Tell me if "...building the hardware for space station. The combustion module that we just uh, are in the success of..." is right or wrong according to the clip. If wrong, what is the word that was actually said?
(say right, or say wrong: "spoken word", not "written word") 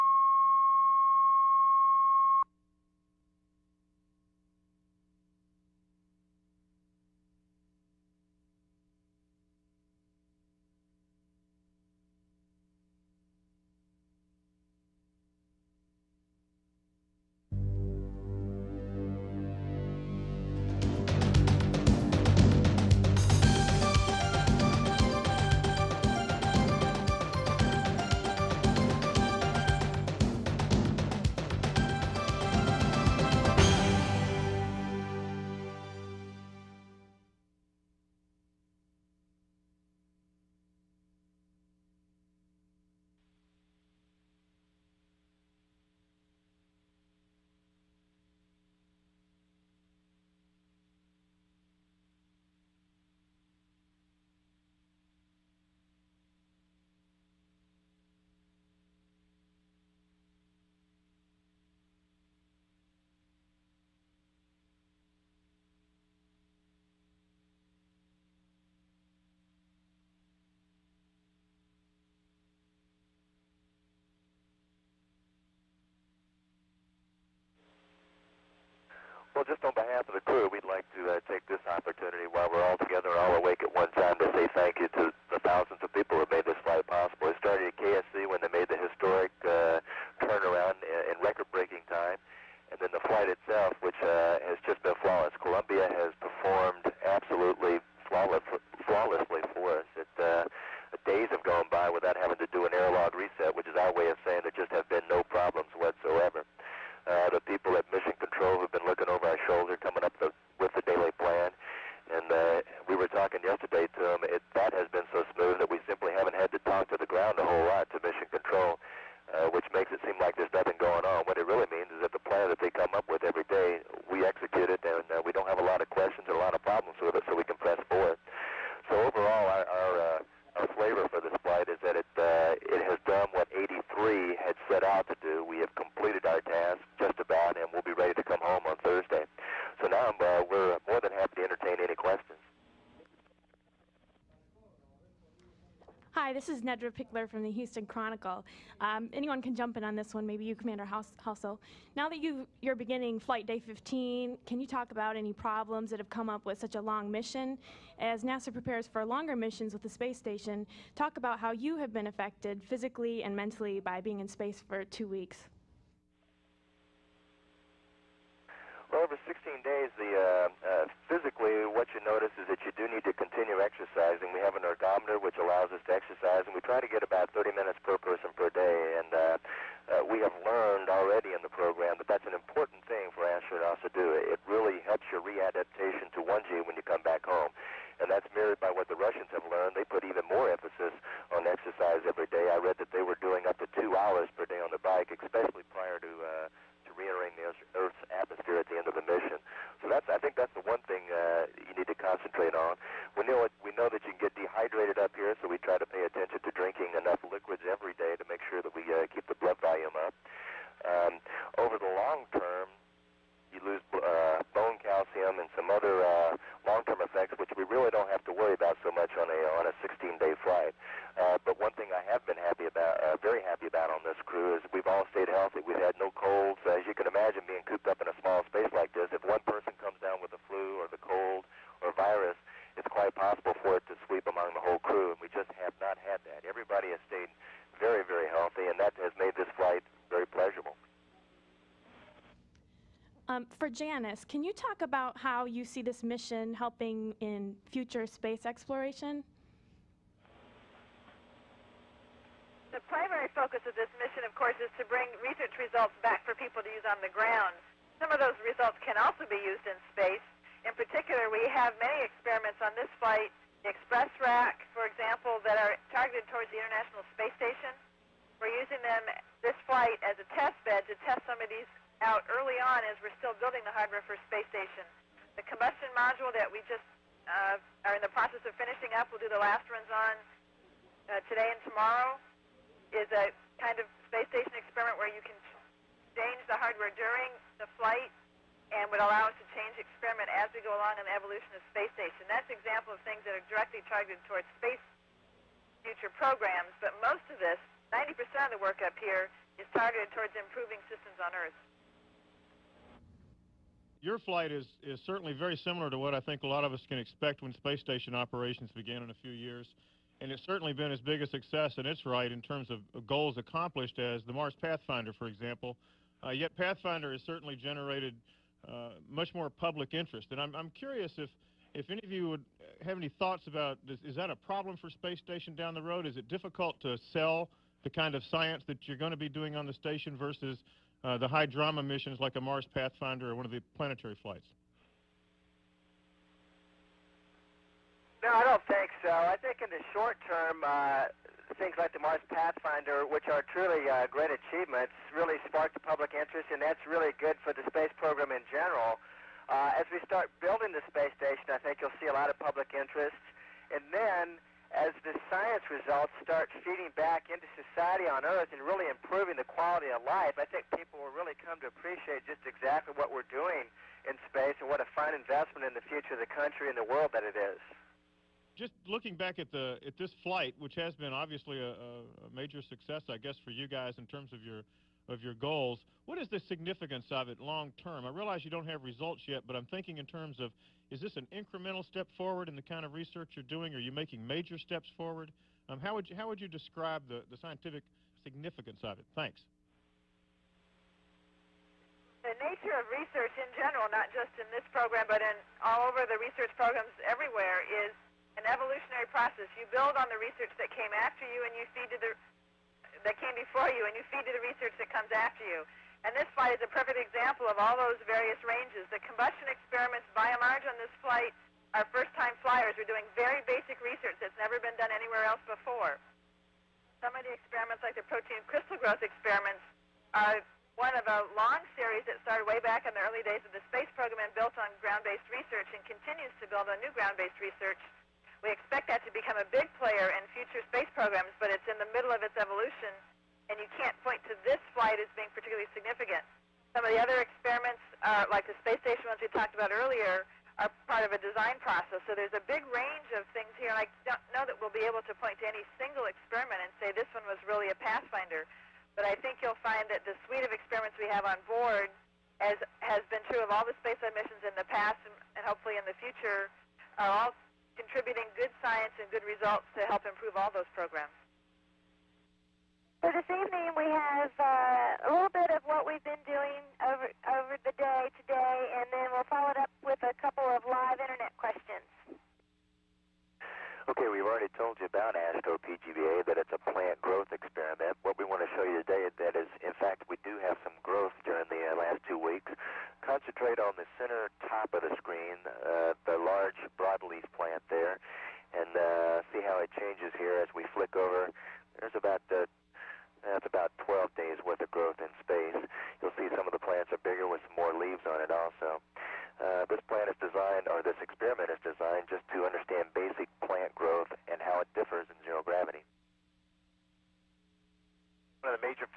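wrong: "process", not "success".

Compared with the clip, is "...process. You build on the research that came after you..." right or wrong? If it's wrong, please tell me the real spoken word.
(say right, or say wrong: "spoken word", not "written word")
right.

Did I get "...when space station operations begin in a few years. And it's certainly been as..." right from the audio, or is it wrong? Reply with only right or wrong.
right.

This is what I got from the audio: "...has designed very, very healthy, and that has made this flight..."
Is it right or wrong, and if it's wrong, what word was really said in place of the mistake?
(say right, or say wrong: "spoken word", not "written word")
wrong: "stayed", not "designed".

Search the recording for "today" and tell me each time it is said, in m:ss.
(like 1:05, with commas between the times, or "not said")
4:41, 7:48, 7:58.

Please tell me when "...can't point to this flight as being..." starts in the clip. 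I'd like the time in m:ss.
7:13.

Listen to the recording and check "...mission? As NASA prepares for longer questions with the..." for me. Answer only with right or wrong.
wrong.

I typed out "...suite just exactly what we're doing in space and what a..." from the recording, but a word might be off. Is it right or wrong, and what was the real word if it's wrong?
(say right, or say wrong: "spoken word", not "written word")
wrong: "appreciate", not "suite".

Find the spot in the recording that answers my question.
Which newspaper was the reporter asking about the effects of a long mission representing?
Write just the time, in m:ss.
2:27.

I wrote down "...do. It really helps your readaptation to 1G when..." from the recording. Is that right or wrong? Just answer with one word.
right.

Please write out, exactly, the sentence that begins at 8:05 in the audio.
Uh, large broadleaf plant there and uh, see how it changes here as we flick over.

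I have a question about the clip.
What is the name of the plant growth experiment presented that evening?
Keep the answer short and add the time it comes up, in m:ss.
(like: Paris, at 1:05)
ASCO PGBA, at 7:55.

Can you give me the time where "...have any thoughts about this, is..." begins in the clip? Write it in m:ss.
5:22.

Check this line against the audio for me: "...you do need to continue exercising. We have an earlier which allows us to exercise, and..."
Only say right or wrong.
wrong.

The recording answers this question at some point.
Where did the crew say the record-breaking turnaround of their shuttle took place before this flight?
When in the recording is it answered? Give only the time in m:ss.
1:27.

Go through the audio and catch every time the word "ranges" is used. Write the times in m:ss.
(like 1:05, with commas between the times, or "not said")
6:48, 7:22.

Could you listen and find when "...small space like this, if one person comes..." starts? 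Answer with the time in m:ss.
3:48.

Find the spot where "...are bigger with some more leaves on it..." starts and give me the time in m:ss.
8:16.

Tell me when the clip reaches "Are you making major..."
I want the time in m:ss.
6:23.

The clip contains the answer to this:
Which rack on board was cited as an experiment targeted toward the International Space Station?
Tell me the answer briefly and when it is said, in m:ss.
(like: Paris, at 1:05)
Express Rack, at 4:23.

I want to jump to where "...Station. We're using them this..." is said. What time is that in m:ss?
4:27.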